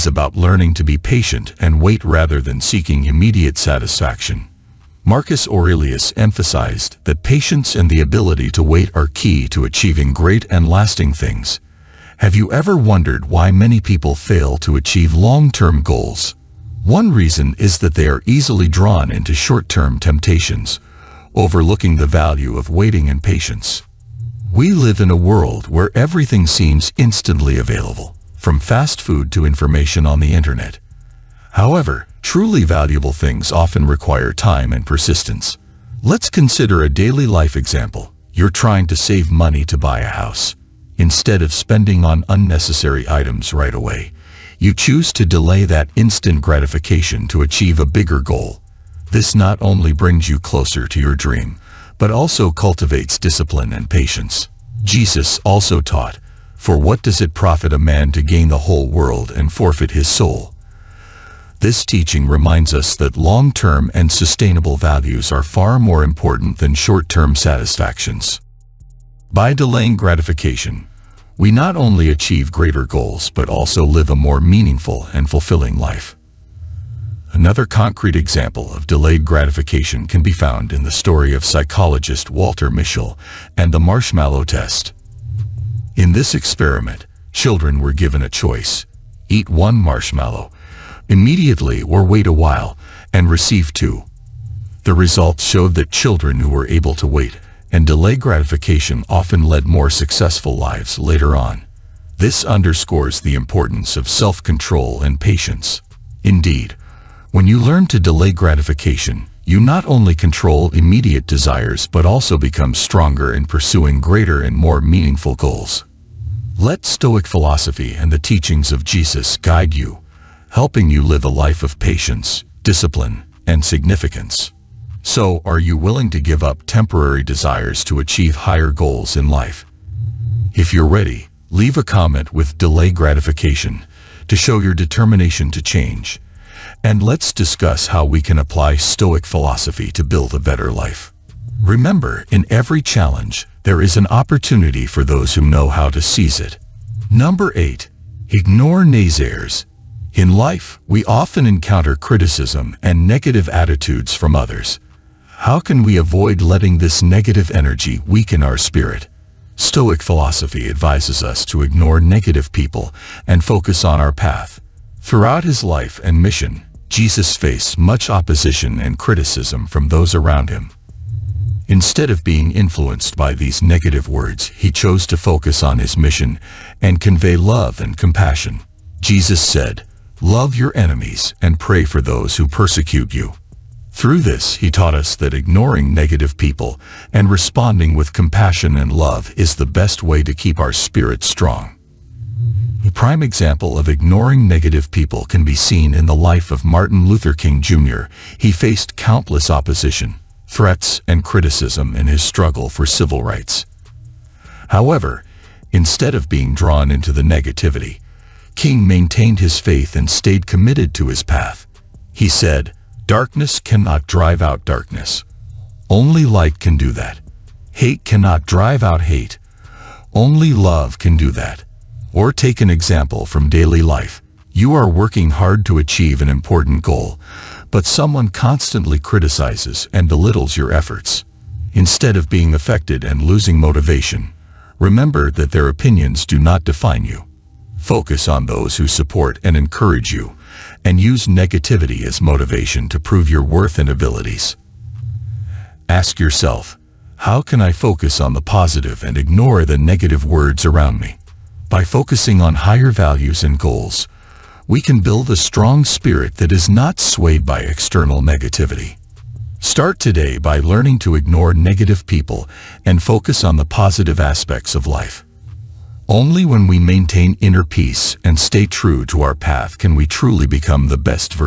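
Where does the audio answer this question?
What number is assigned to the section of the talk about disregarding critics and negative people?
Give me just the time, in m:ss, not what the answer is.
2:27.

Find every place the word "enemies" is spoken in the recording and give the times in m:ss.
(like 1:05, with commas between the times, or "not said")
3:00.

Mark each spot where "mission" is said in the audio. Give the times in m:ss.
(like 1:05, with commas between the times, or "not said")
2:46, 2:55.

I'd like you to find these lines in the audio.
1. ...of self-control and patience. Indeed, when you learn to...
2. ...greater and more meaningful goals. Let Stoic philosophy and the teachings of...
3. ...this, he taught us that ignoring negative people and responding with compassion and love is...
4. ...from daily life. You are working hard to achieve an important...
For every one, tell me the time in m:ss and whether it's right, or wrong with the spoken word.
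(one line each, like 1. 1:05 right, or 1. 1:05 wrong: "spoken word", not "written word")
1. 1:43 right
2. 1:53 right
3. 3:04 right
4. 3:43 right.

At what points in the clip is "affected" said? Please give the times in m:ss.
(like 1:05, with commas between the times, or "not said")
3:52.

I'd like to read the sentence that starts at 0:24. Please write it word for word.
We live in a world where everything seems instantly available, from fast food to information on the internet.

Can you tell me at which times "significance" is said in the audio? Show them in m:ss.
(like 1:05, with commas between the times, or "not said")
2:03.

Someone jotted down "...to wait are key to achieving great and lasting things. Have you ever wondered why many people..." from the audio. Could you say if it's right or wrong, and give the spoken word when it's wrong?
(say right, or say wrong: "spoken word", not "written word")
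right.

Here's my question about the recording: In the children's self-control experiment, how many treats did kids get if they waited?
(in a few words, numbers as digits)
2.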